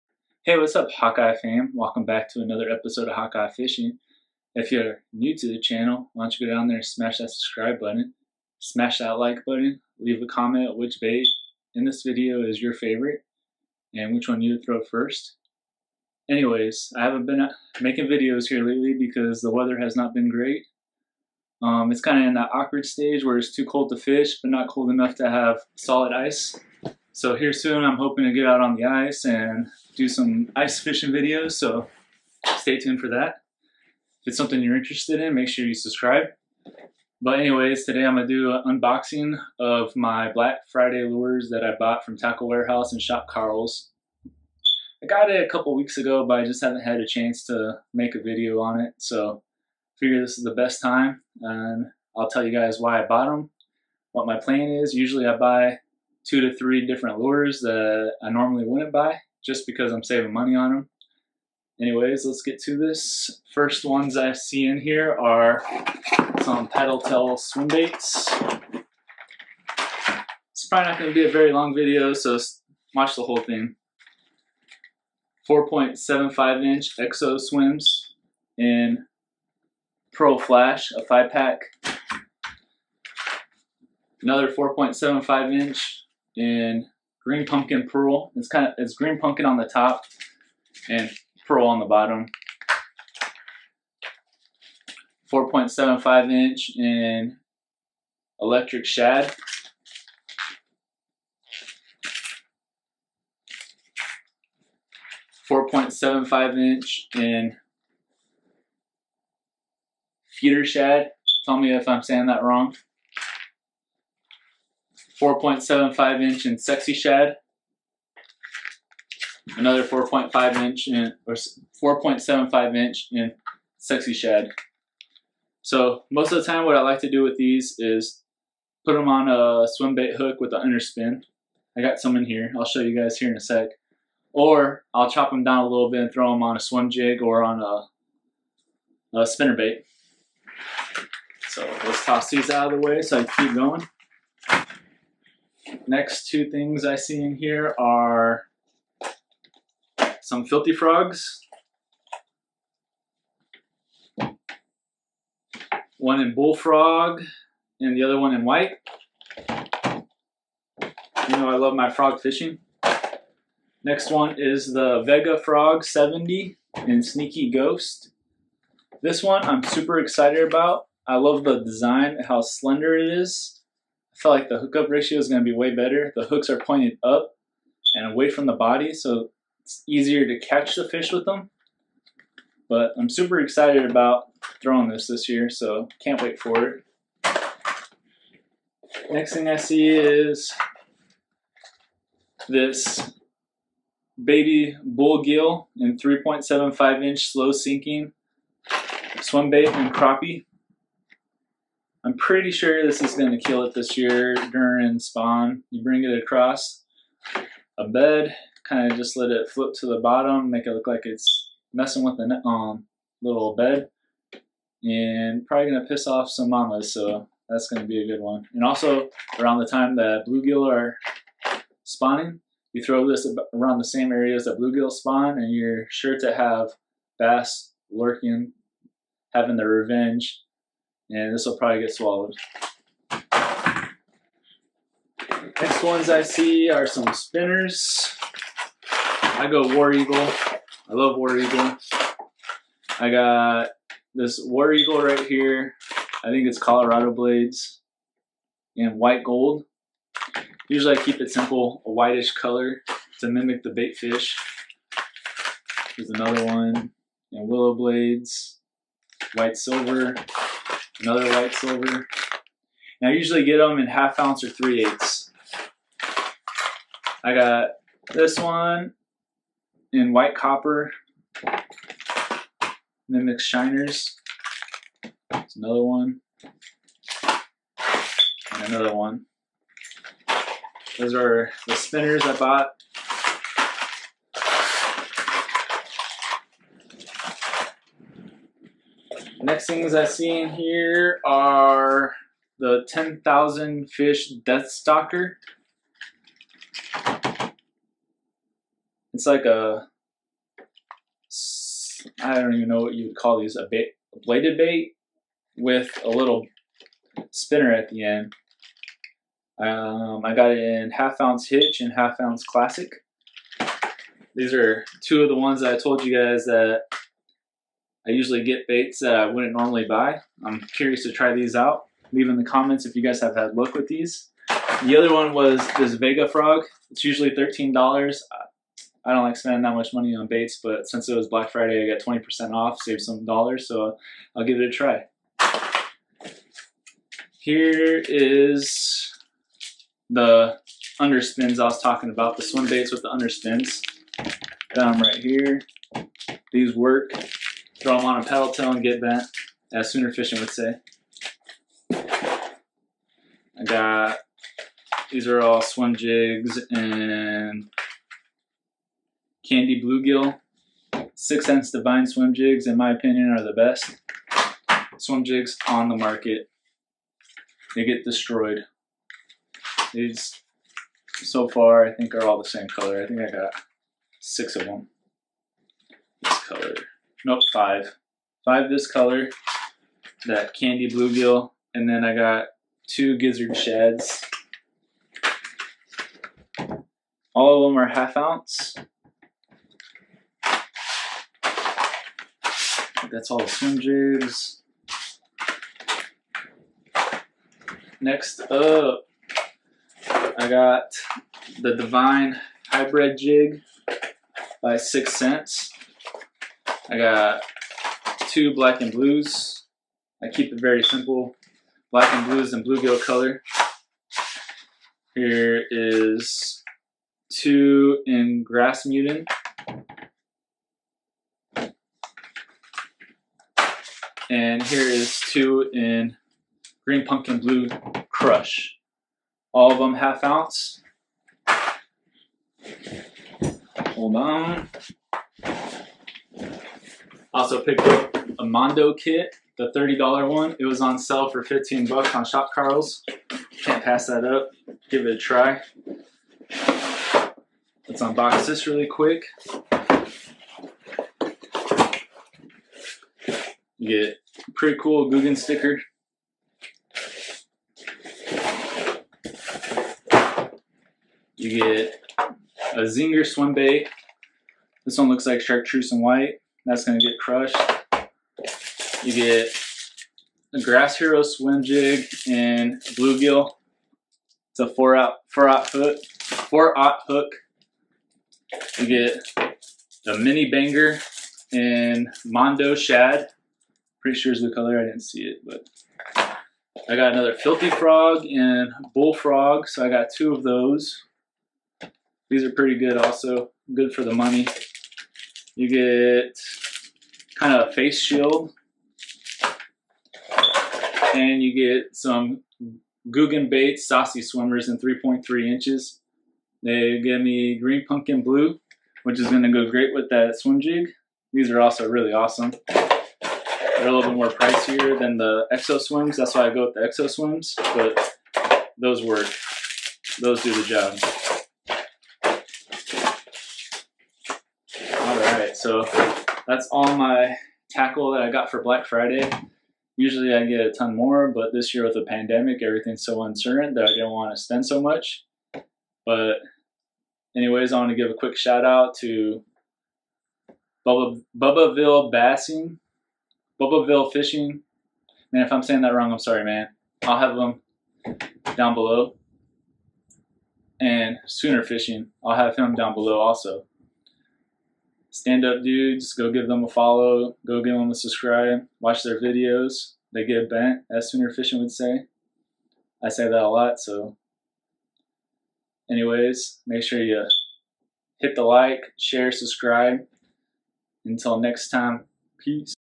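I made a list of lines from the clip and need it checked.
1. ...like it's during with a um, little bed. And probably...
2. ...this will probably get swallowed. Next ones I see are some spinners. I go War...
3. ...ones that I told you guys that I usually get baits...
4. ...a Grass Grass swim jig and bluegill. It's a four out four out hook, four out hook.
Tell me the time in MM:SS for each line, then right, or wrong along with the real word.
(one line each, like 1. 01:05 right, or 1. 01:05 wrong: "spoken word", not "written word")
1. 03:30 wrong: "messing", not "during"
2. 03:51 right
3. 05:15 right
4. 07:50 wrong: "Hero", not "Grass".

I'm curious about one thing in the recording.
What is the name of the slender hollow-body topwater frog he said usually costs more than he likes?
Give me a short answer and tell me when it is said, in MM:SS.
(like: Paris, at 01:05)
Vega Frog 70, at 02:45.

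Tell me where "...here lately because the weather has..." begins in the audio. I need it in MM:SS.
00:18.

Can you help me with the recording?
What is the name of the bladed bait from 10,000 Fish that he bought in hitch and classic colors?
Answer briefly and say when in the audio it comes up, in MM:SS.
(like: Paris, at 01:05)
Death Stalker, at 04:54.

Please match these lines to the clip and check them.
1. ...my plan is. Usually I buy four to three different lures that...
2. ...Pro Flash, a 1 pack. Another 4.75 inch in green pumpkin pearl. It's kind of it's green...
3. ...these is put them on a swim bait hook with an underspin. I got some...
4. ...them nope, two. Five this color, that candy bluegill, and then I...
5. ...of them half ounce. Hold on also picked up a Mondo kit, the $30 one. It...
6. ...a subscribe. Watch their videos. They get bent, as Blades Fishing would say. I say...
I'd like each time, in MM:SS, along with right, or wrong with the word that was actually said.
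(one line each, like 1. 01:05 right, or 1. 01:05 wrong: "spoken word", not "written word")
1. 00:54 wrong: "two", not "four"
2. 01:20 wrong: "5", not "1"
3. 02:07 right
4. 06:14 wrong: "five", not "two"
5. 07:09 right
6. 09:17 wrong: "Sooner", not "Blades".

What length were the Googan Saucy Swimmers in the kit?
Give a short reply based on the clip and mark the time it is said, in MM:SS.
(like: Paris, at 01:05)
3.3 inches, at 08:24.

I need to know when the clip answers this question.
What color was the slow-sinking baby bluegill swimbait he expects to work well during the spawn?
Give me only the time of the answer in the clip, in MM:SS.
03:19.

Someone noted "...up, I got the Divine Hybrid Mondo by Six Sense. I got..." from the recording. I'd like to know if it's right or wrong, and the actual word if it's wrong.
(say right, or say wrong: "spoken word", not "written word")
wrong: "Jig", not "Mondo".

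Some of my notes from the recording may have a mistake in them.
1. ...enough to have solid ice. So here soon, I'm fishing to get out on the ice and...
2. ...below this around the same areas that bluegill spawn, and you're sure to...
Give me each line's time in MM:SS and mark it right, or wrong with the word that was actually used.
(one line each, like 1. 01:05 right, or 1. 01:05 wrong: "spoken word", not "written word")
1. 00:24 wrong: "hoping", not "fishing"
2. 03:42 wrong: "throw", not "below".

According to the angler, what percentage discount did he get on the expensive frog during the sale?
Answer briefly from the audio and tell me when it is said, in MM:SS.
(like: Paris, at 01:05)
20%, at 05:32.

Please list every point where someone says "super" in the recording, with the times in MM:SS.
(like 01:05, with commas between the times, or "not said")
02:49, 03:03.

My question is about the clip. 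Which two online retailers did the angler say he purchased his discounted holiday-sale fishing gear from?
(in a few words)
Tackle Warehouse and Shop Karl's.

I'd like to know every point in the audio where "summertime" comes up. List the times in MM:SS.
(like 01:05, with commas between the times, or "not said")
not said.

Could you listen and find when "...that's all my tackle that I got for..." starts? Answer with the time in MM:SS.
08:46.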